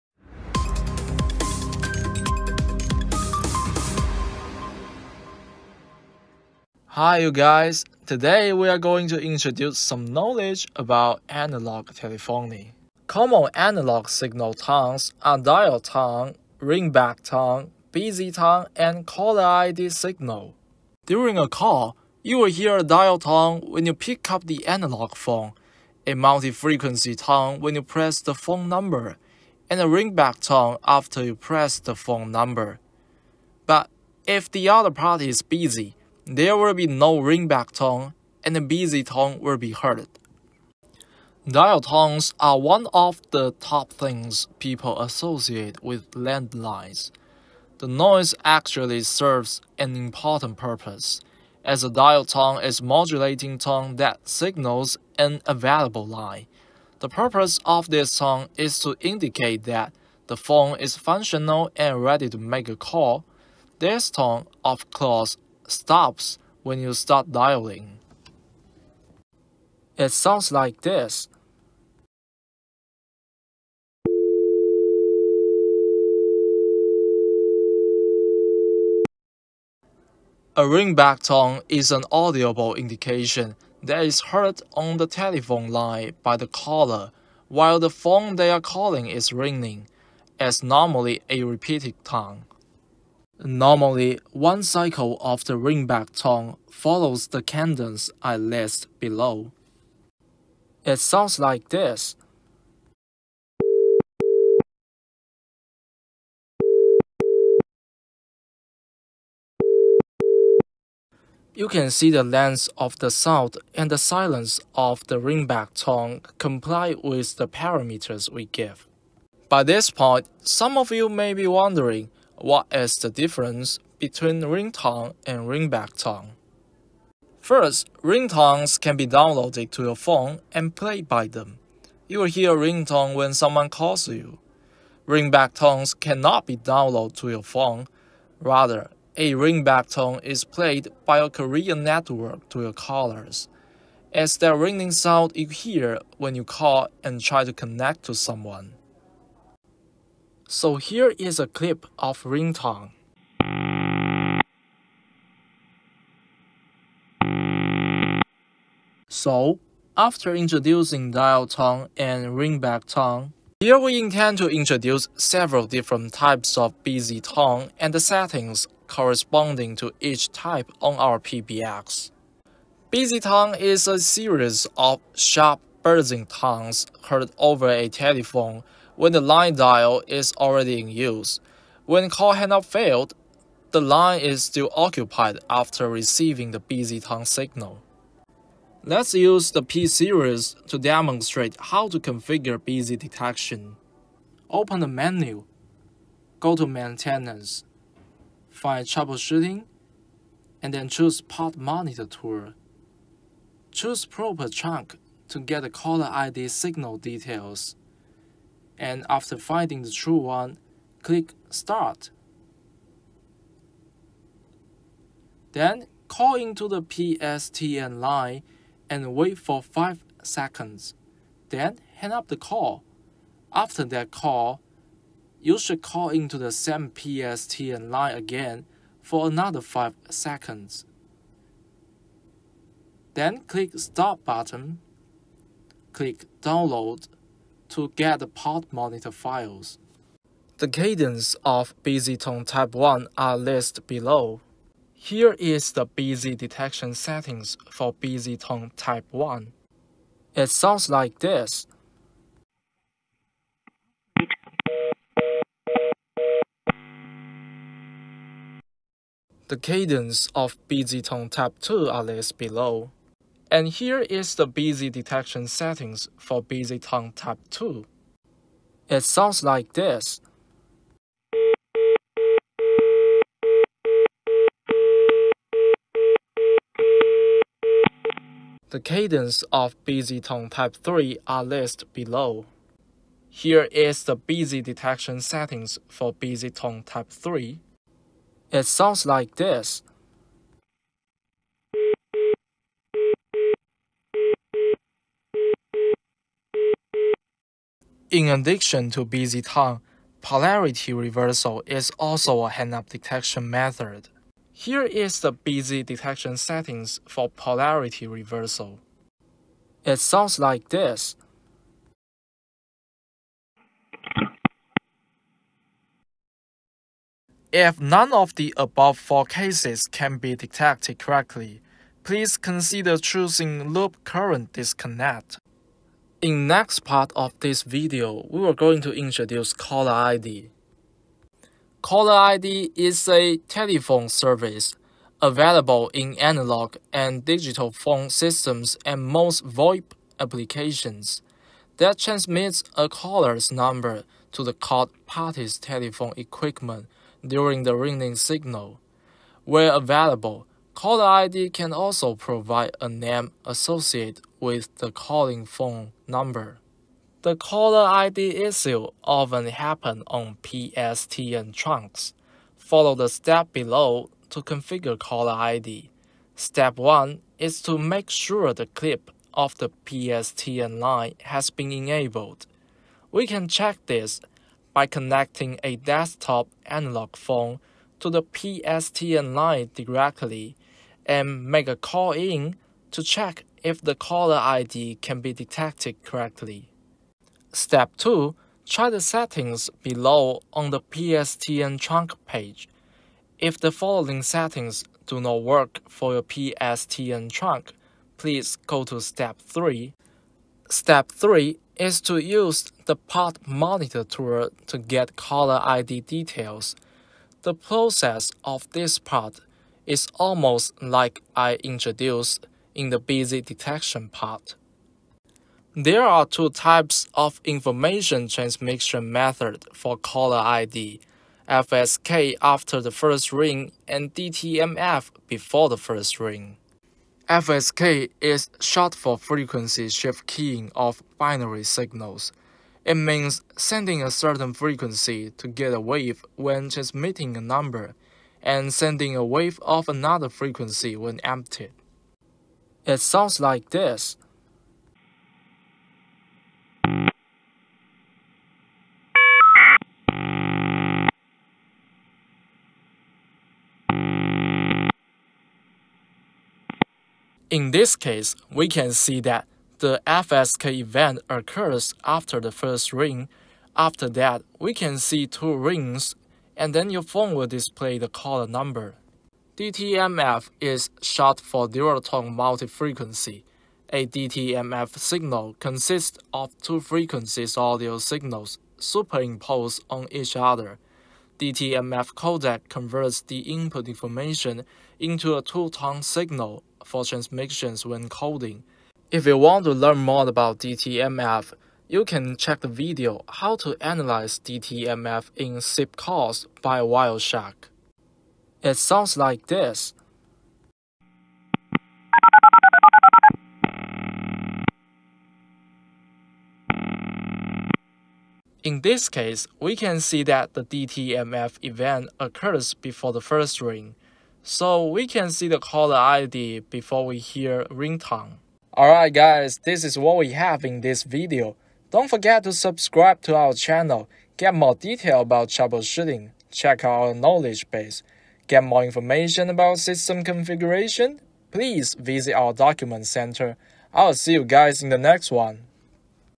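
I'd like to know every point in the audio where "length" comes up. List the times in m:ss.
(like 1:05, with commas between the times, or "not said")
1:52.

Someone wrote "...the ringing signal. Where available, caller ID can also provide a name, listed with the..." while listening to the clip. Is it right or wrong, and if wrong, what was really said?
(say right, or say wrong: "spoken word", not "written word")
wrong: "associated", not "listed".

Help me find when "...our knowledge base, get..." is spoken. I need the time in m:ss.
8:46.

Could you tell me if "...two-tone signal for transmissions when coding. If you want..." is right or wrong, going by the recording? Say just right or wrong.
right.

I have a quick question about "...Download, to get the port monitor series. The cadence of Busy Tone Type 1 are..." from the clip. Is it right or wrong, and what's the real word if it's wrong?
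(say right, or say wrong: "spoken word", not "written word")
wrong: "files", not "series".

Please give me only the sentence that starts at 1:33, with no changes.
Normally, one cycle of the ringback tone follows the cadence I list below.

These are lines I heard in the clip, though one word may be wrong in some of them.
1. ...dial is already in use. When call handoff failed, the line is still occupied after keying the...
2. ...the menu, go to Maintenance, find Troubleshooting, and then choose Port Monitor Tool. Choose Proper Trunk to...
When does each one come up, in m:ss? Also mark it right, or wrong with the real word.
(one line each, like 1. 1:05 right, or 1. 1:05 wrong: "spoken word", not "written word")
1. 2:59 wrong: "receiving", not "keying"
2. 3:14 right.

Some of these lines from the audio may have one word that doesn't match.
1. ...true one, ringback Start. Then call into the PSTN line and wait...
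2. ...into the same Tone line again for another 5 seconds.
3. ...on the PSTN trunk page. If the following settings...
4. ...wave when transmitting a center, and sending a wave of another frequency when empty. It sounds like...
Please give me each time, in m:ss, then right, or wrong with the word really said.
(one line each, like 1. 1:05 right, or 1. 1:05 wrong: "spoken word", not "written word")
1. 3:29 wrong: "click", not "ringback"
2. 3:46 wrong: "PSTN", not "Tone"
3. 6:30 right
4. 7:15 wrong: "number", not "center".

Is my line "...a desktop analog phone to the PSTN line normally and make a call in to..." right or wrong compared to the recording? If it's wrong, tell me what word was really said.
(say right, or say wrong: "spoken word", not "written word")
wrong: "directly", not "normally".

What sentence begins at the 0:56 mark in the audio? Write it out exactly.
The purpose of this tone is to indicate that the phone is functional and ready to make a call.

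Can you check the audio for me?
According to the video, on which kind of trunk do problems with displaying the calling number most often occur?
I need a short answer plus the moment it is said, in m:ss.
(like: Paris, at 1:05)
PSTN trunks, at 6:00.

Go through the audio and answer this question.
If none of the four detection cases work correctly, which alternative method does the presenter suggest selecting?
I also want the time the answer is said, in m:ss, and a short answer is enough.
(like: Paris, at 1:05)
Loop current disconnect, at 5:23.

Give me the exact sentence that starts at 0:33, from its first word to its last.
But if the other party is busy, there will be no ringback tone, and the busy tone will be heard.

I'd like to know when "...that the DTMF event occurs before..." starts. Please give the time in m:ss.
8:30.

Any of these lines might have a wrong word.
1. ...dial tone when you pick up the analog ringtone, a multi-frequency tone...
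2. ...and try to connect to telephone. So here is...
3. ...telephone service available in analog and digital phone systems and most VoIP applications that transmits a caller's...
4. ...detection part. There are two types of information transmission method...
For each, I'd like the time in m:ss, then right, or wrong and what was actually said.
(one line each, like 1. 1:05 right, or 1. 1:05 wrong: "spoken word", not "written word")
1. 0:22 wrong: "phone", not "ringtone"
2. 2:27 wrong: "someone", not "telephone"
3. 5:33 right
4. 6:53 right.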